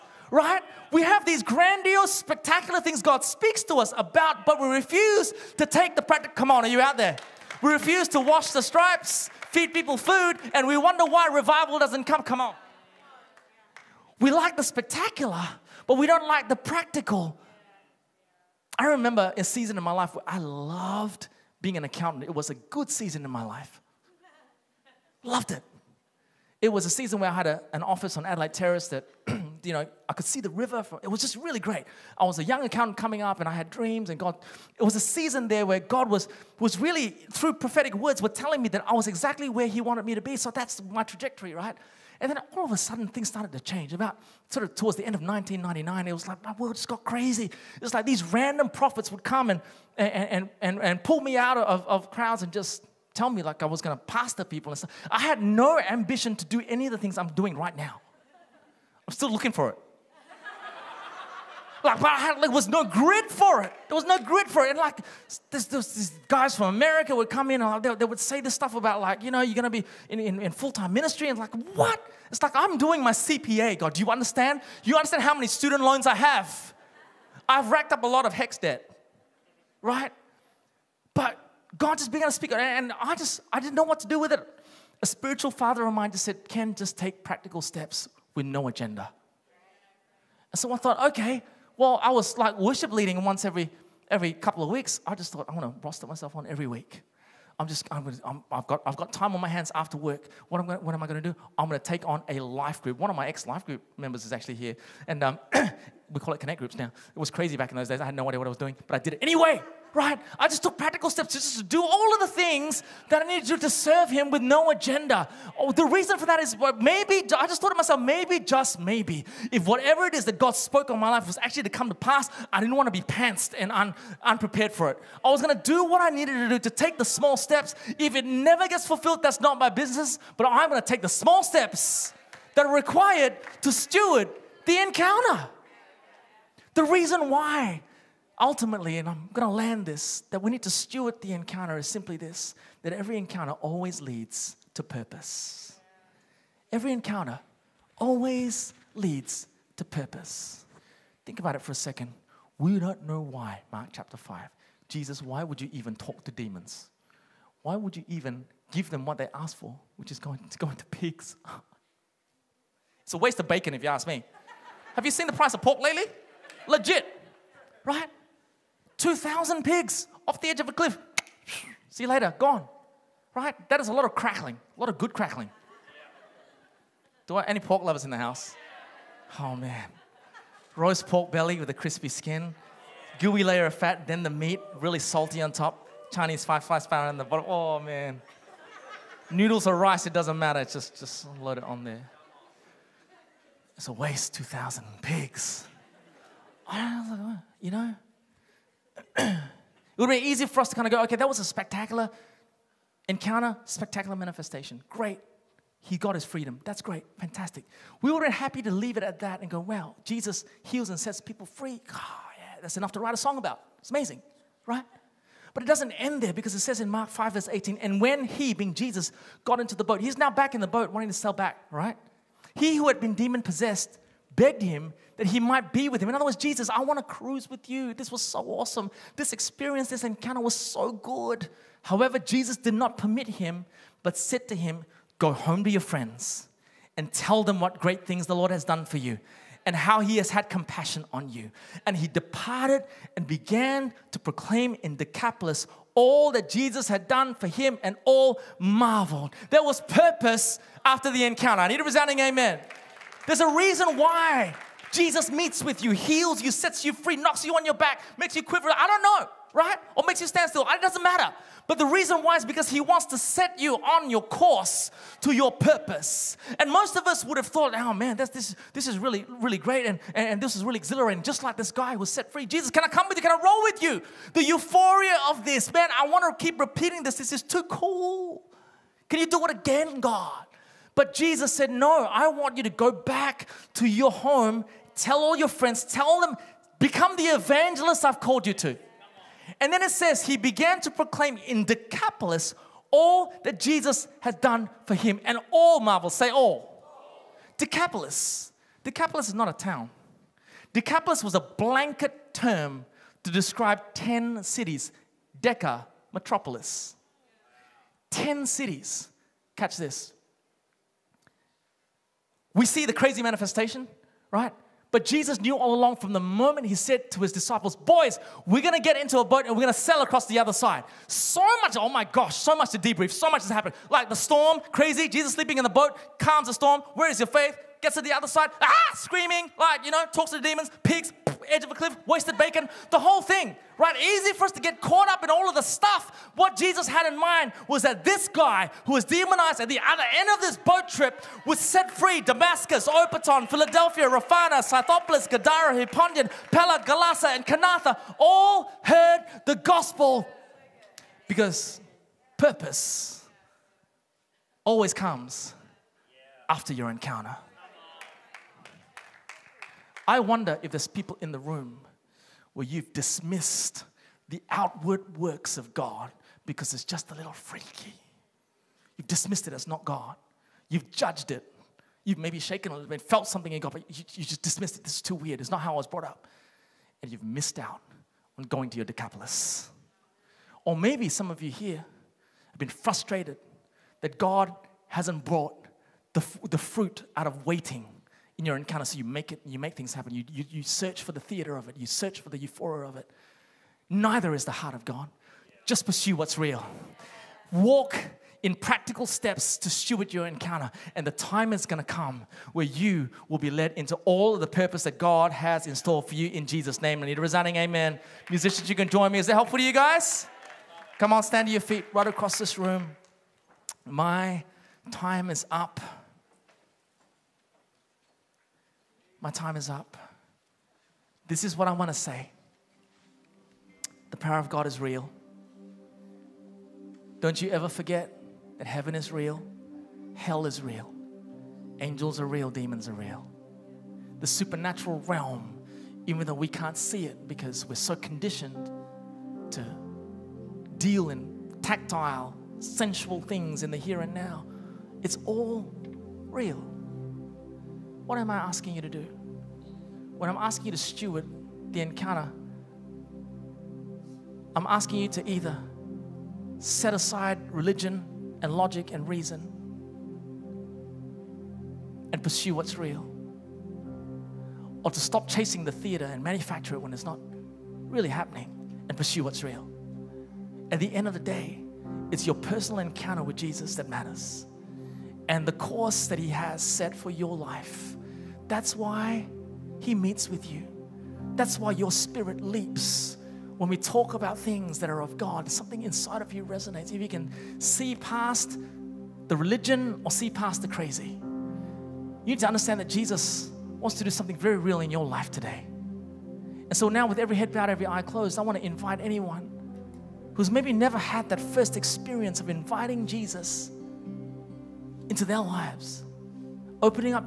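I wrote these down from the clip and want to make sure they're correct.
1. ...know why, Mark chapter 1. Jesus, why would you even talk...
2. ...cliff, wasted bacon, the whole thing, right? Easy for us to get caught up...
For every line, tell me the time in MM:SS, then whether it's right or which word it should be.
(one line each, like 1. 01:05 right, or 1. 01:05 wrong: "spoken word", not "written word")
1. 02:33 wrong: "5", not "1"
2. 05:31 right.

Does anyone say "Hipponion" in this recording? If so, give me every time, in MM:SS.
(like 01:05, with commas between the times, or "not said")
05:45.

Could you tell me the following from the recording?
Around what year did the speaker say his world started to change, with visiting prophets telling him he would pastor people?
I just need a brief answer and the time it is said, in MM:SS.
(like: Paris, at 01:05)
1999, at 00:45.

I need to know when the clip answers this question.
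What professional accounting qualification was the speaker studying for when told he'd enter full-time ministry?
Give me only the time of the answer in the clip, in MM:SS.
01:13.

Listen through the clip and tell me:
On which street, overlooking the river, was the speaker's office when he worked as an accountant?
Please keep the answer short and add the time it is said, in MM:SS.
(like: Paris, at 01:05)
Adelaide Terrace, at 00:28.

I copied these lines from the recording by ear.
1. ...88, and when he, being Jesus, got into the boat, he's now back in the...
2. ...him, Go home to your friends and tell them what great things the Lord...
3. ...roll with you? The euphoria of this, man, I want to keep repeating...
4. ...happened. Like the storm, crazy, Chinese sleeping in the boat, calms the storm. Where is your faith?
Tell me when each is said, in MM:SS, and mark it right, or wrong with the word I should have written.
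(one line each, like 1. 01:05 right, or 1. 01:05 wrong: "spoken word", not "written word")
1. 03:37 wrong: "18", not "88"
2. 03:54 right
3. 04:33 right
4. 05:23 wrong: "Jesus", not "Chinese".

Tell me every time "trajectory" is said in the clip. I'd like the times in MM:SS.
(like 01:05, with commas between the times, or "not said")
00:41.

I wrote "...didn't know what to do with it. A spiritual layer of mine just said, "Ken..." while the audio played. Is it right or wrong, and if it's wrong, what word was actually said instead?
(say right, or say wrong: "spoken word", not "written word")
wrong: "father", not "layer".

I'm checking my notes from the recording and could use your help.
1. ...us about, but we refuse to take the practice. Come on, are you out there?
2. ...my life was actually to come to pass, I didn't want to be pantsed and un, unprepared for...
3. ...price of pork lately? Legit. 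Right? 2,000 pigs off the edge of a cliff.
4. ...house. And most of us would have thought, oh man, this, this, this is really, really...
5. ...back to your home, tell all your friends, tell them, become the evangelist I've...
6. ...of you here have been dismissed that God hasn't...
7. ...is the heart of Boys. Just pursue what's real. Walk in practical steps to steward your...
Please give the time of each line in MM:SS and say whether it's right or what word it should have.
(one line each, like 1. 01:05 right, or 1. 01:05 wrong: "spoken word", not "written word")
1. 00:03 right
2. 02:00 right
3. 02:45 right
4. 04:25 wrong: "purpose", not "house"
5. 04:42 right
6. 06:21 wrong: "frustrated", not "dismissed"
7. 06:34 wrong: "God", not "Boys".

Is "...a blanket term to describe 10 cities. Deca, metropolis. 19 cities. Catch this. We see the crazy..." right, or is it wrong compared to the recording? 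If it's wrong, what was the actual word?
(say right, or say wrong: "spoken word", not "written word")
wrong: "10", not "19".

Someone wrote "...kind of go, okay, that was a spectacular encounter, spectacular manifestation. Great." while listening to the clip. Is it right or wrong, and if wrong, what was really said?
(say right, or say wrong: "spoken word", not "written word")
right.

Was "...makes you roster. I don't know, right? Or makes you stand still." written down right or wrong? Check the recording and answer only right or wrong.
wrong.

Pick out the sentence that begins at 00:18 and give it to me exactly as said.
I remember a season in my life where I loved being an accountant.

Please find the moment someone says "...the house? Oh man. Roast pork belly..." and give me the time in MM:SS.
02:58.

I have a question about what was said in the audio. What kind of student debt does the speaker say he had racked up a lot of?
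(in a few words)
HECS debt.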